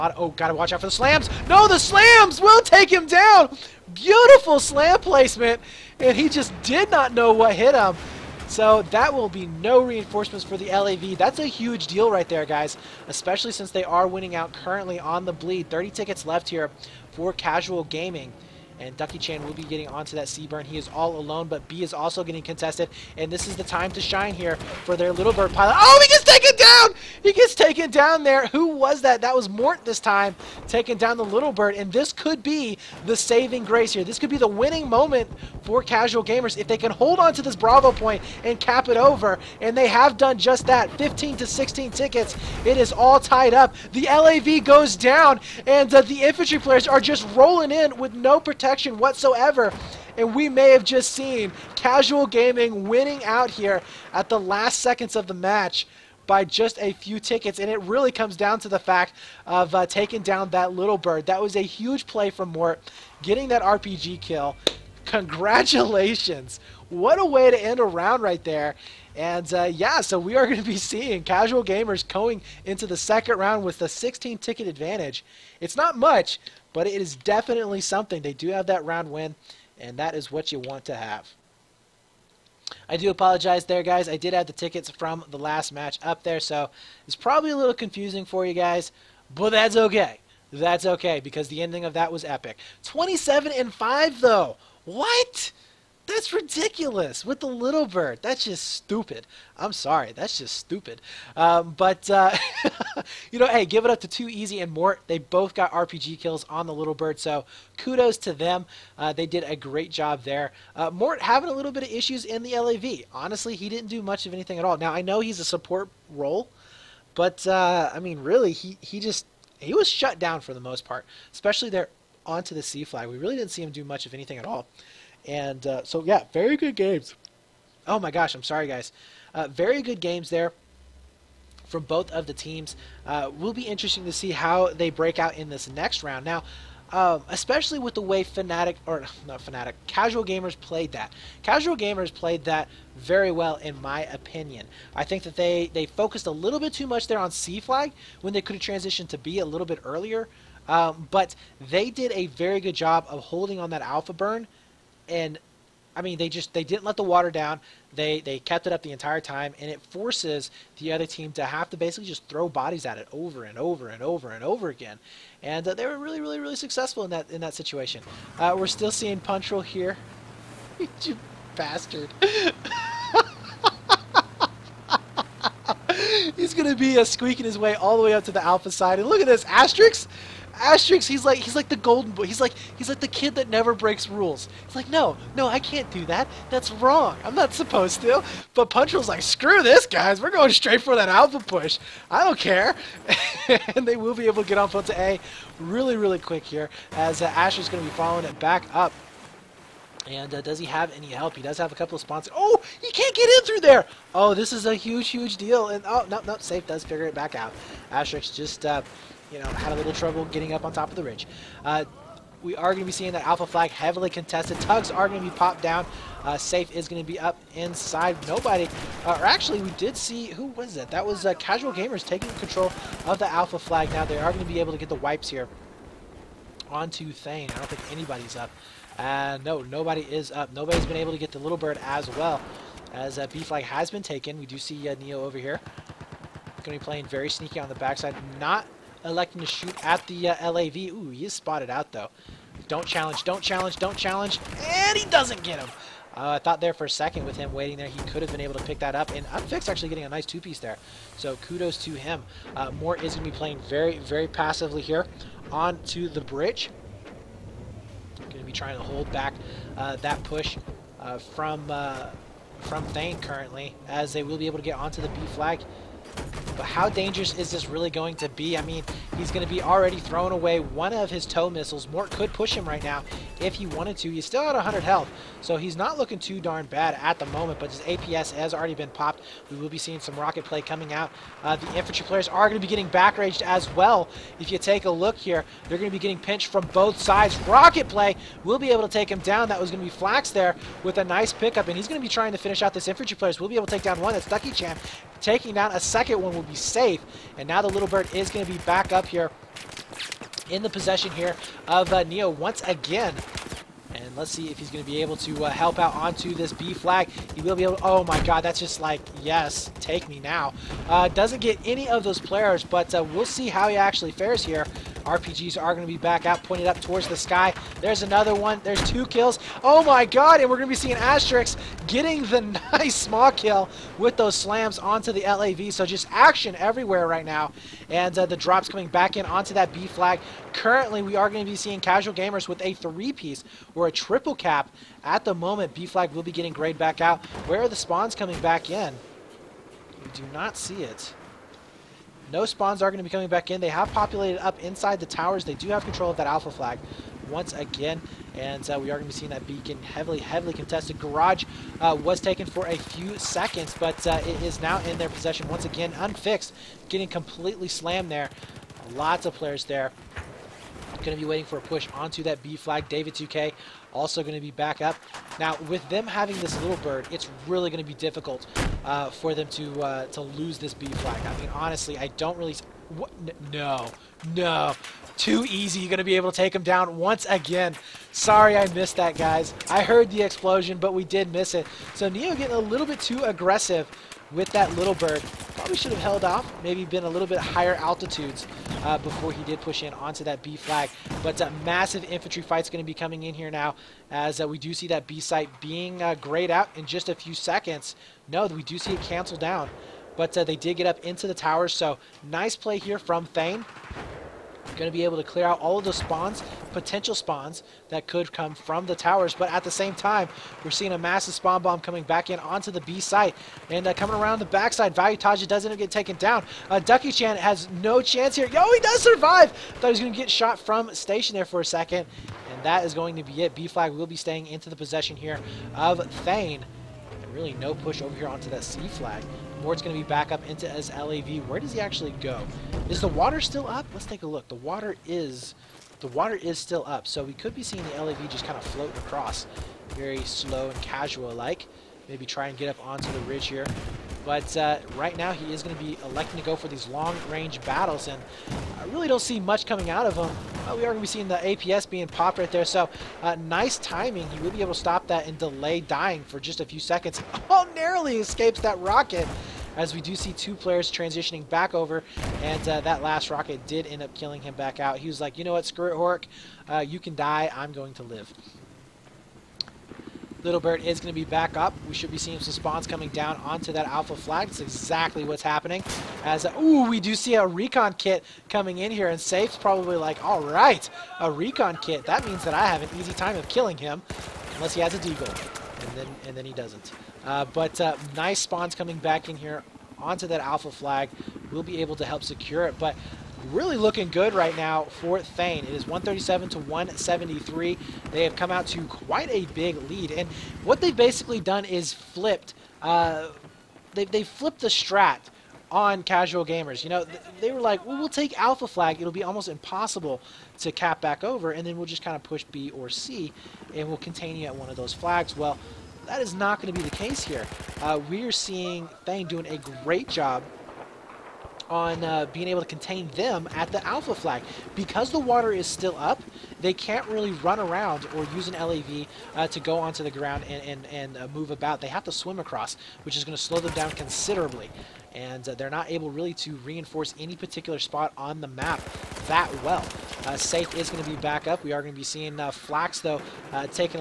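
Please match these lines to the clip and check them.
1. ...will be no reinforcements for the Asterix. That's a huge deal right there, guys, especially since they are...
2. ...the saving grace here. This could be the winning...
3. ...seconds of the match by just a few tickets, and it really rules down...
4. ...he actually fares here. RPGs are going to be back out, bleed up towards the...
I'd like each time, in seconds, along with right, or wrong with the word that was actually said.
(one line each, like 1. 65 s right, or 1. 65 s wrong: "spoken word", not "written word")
1. 9 s wrong: "LAV", not "Asterix"
2. 33 s right
3. 54 s wrong: "comes", not "rules"
4. 313 s wrong: "pointed", not "bleed".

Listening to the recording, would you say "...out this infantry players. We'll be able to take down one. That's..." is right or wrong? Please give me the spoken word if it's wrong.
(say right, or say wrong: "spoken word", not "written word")
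right.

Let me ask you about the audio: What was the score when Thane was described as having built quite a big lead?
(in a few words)
137 to 173.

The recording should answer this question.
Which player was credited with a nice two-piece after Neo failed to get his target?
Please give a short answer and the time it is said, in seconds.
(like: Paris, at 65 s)
Unfix, at 249 s.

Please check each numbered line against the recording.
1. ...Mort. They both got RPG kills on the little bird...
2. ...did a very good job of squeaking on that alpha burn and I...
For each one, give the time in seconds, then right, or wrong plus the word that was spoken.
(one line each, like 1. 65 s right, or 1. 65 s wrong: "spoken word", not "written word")
1. 104 s right
2. 151 s wrong: "holding", not "squeaking".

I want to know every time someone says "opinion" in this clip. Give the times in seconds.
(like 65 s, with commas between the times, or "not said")
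144 s.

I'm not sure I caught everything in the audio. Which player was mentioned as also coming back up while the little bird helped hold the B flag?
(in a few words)
David 2K.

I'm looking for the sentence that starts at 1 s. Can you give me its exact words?
No, the slams will take him down.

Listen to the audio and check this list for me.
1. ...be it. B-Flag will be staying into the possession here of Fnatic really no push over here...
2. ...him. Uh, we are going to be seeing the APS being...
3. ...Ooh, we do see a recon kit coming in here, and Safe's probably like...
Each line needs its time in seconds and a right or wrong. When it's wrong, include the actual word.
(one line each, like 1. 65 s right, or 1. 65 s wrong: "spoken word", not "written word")
1. 423 s wrong: "Thane", not "Fnatic"
2. 450 s right
3. 476 s right.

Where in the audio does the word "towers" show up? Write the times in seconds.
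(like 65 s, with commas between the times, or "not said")
345 s, 401 s, 408 s.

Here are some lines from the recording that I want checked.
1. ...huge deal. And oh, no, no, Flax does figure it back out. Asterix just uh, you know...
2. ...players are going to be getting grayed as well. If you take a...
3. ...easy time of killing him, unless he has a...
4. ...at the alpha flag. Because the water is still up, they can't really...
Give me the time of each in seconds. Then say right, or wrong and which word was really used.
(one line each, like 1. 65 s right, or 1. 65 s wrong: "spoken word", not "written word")
1. 205 s wrong: "Safe", not "Flax"
2. 282 s wrong: "backraged", not "grayed"
3. 482 s right
4. 523 s right.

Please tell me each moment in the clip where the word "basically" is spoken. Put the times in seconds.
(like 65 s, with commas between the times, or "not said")
161 s, 500 s.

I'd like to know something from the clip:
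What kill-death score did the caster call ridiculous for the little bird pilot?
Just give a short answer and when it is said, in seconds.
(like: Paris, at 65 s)
27 and 5, at 92 s.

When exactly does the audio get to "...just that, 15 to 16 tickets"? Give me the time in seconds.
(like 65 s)
40 s.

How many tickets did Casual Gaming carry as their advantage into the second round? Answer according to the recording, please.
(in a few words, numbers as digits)
16.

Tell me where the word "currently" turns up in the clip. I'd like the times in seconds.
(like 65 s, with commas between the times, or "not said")
14 s, 263 s, 330 s.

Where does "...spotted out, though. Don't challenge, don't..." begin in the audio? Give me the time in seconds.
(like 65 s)
241 s.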